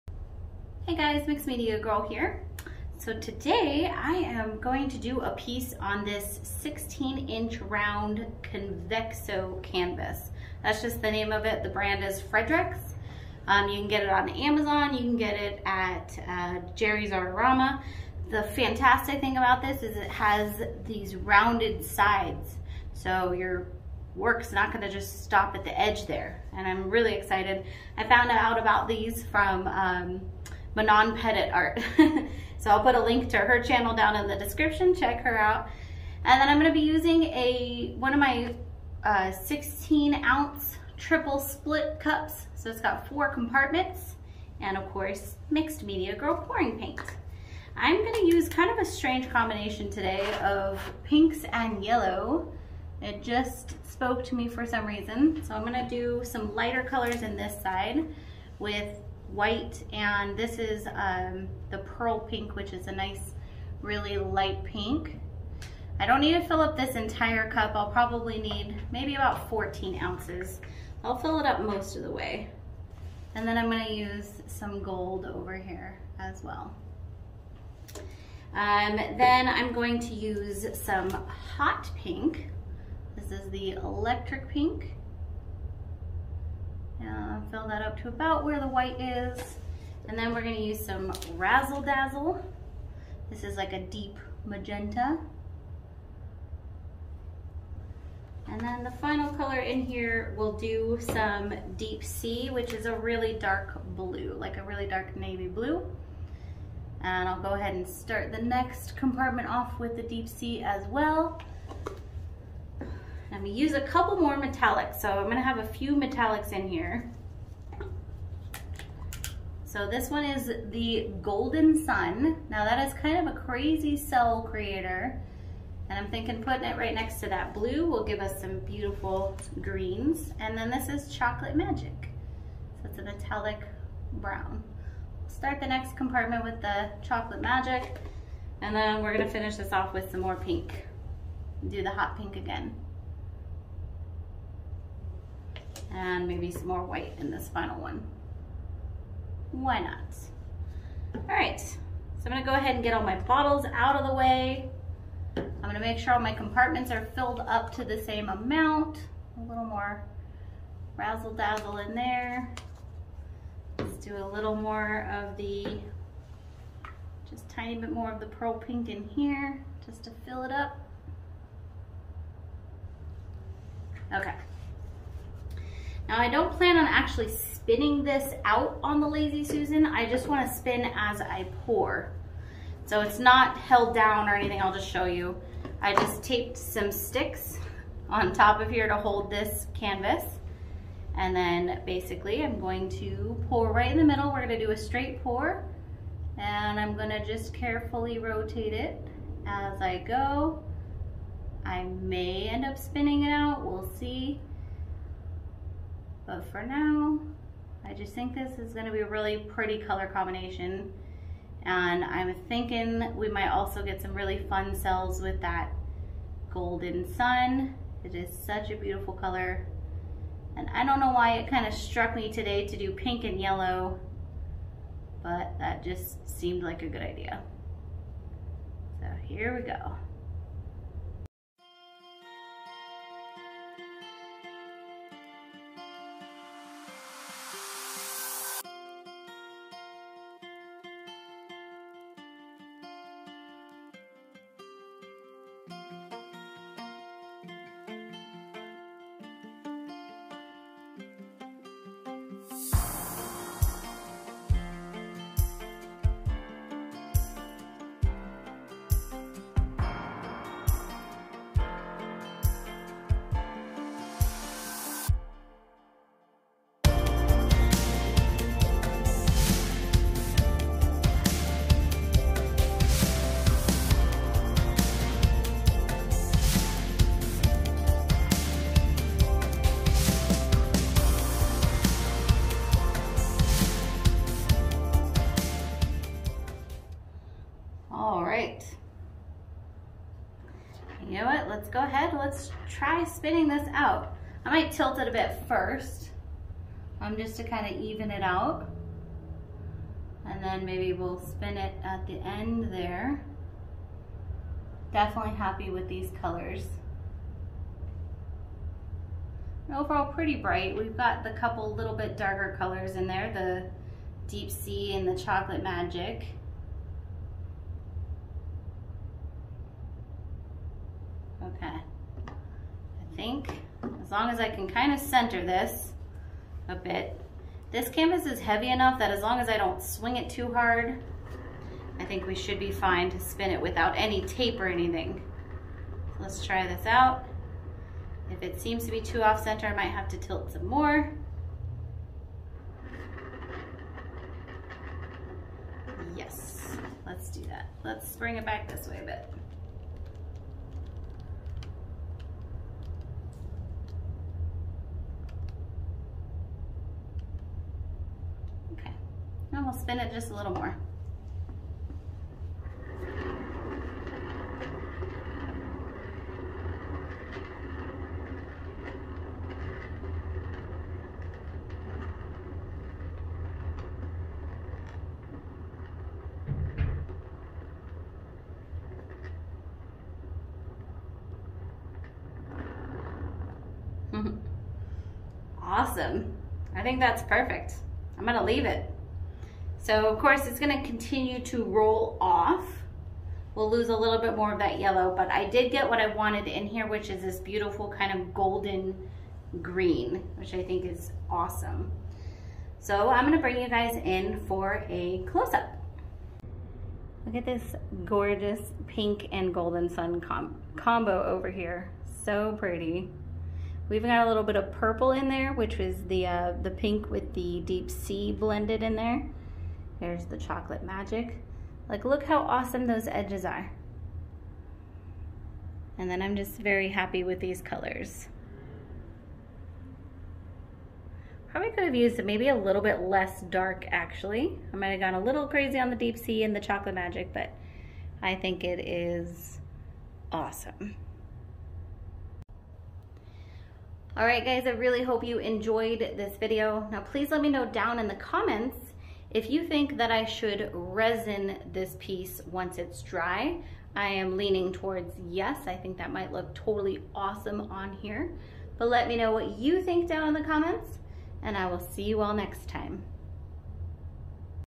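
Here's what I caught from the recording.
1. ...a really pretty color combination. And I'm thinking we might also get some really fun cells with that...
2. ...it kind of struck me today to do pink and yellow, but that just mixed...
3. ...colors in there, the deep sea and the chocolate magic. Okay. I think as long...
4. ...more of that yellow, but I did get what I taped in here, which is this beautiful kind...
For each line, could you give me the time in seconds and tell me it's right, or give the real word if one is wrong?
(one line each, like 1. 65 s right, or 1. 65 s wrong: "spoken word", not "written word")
1. 208 s right
2. 221 s wrong: "seemed", not "mixed"
3. 312 s right
4. 394 s wrong: "wanted", not "taped".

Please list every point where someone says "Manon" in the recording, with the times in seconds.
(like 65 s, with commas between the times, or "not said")
30 s.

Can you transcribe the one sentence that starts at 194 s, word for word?
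We're gonna do a straight pour and I'm gonna just carefully rotate it as I go.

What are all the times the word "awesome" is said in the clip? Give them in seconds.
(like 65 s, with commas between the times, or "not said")
385 s, 401 s, 422 s, 440 s, 457 s.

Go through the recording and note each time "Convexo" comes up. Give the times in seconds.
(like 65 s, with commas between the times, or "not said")
8 s.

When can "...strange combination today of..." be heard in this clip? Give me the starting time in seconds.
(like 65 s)
48 s.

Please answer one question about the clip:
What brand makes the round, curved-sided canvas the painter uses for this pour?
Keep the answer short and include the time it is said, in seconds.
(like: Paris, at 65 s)
Fredrix, at 12 s.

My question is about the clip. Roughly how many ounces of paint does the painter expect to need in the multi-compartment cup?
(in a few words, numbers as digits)
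14 ounces.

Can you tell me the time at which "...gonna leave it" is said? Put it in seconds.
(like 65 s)
388 s.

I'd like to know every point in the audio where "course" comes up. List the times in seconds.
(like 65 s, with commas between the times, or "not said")
44 s, 390 s.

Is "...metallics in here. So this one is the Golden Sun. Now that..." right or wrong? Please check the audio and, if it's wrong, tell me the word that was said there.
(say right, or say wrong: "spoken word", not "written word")
right.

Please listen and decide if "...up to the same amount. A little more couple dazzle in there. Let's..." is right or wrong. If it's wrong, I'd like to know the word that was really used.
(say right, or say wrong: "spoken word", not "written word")
wrong: "razzle", not "couple".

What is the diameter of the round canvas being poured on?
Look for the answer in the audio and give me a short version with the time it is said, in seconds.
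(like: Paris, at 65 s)
16 inches, at 6 s.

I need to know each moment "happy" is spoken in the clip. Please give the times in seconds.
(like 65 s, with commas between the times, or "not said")
305 s, 426 s.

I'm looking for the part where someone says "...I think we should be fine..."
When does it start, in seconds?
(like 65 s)
331 s.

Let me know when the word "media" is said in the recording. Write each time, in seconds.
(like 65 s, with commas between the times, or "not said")
1 s, 45 s.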